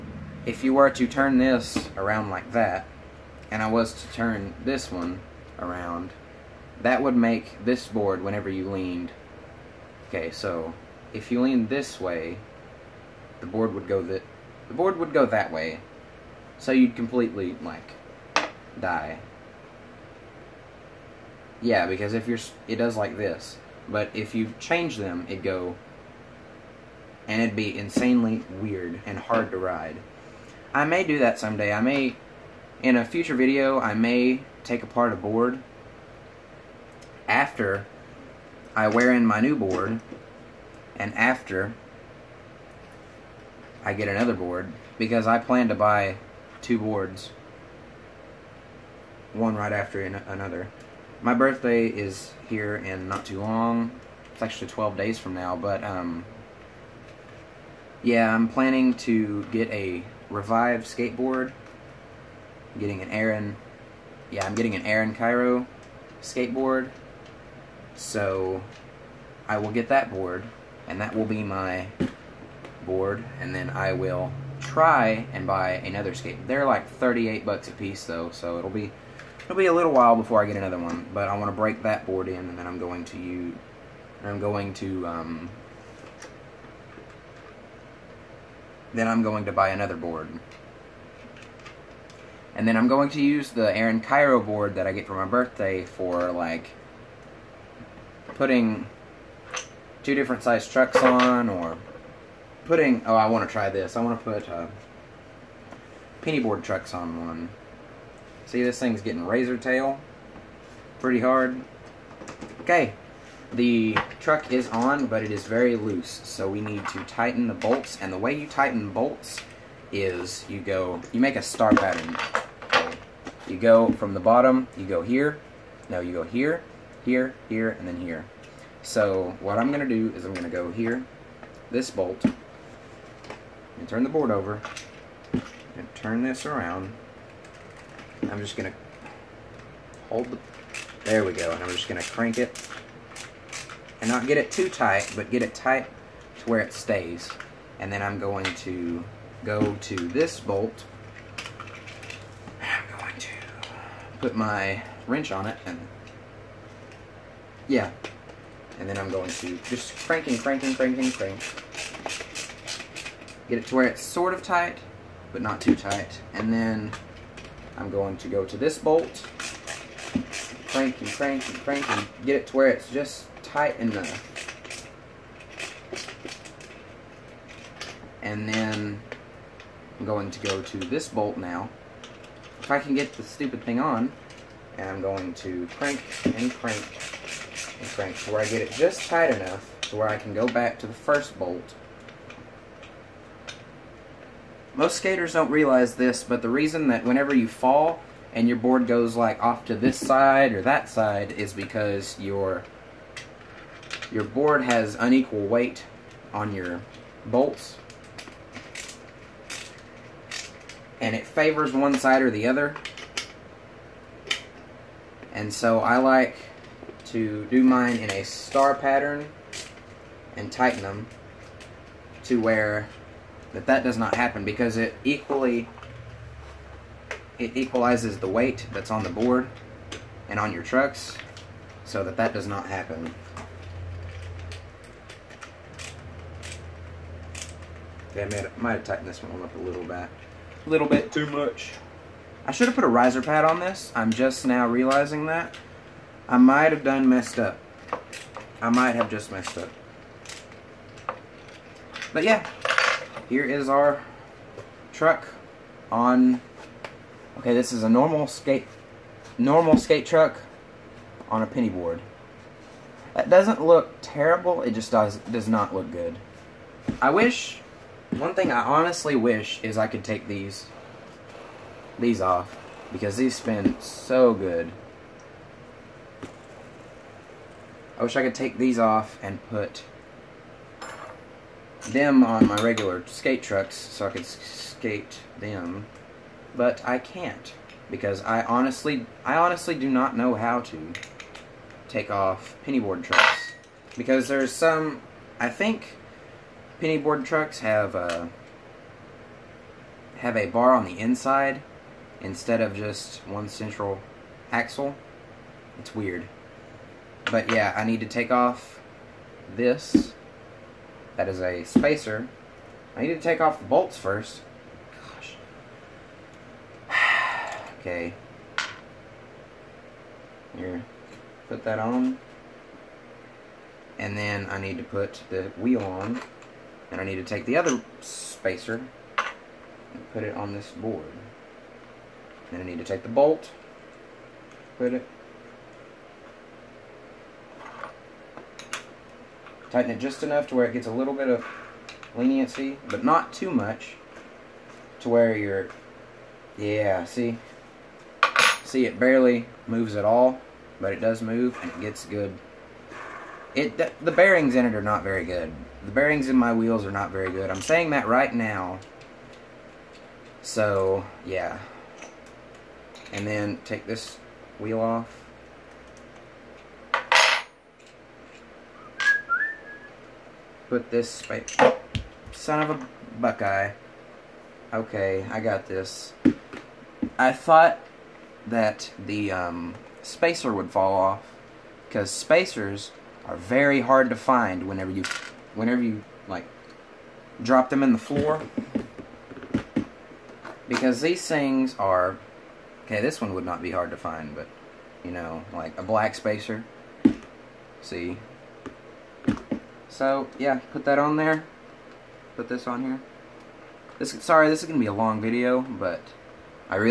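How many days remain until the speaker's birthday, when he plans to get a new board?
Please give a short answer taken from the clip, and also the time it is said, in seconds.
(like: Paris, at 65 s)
12, at 54 s.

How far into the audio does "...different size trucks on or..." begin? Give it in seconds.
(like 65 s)
100 s.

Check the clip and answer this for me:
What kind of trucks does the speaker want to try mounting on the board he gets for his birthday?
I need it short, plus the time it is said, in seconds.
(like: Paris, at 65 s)
penny board trucks, at 106 s.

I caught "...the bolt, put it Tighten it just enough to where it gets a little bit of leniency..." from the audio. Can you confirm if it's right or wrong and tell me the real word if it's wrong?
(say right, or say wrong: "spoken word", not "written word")
right.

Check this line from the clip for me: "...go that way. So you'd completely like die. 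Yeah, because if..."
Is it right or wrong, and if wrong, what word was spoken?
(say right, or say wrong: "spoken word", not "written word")
right.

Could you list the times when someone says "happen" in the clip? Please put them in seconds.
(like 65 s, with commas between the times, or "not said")
224 s, 232 s.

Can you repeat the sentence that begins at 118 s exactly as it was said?
And the way you tighten bolts is you go, you make a star pattern.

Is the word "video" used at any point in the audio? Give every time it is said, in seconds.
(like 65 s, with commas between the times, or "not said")
33 s, 405 s.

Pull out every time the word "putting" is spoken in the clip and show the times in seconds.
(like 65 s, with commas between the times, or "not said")
98 s, 102 s.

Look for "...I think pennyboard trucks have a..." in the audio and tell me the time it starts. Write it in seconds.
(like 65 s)
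295 s.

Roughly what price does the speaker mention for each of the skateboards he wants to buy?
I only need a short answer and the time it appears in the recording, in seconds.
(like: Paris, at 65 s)
38 bucks, at 76 s.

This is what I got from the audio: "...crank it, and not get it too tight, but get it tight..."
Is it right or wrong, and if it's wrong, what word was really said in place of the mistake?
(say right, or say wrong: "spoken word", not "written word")
right.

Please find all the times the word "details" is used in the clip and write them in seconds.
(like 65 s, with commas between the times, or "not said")
not said.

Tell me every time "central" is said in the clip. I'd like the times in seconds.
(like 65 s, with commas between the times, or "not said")
303 s.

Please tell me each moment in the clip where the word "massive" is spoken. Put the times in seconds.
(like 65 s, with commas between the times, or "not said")
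not said.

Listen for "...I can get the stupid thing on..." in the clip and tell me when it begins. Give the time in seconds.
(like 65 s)
182 s.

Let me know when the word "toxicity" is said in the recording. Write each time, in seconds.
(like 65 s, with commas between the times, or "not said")
not said.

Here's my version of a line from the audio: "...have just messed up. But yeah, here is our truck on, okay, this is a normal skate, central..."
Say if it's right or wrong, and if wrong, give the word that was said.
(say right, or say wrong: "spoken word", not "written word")
wrong: "normal", not "central".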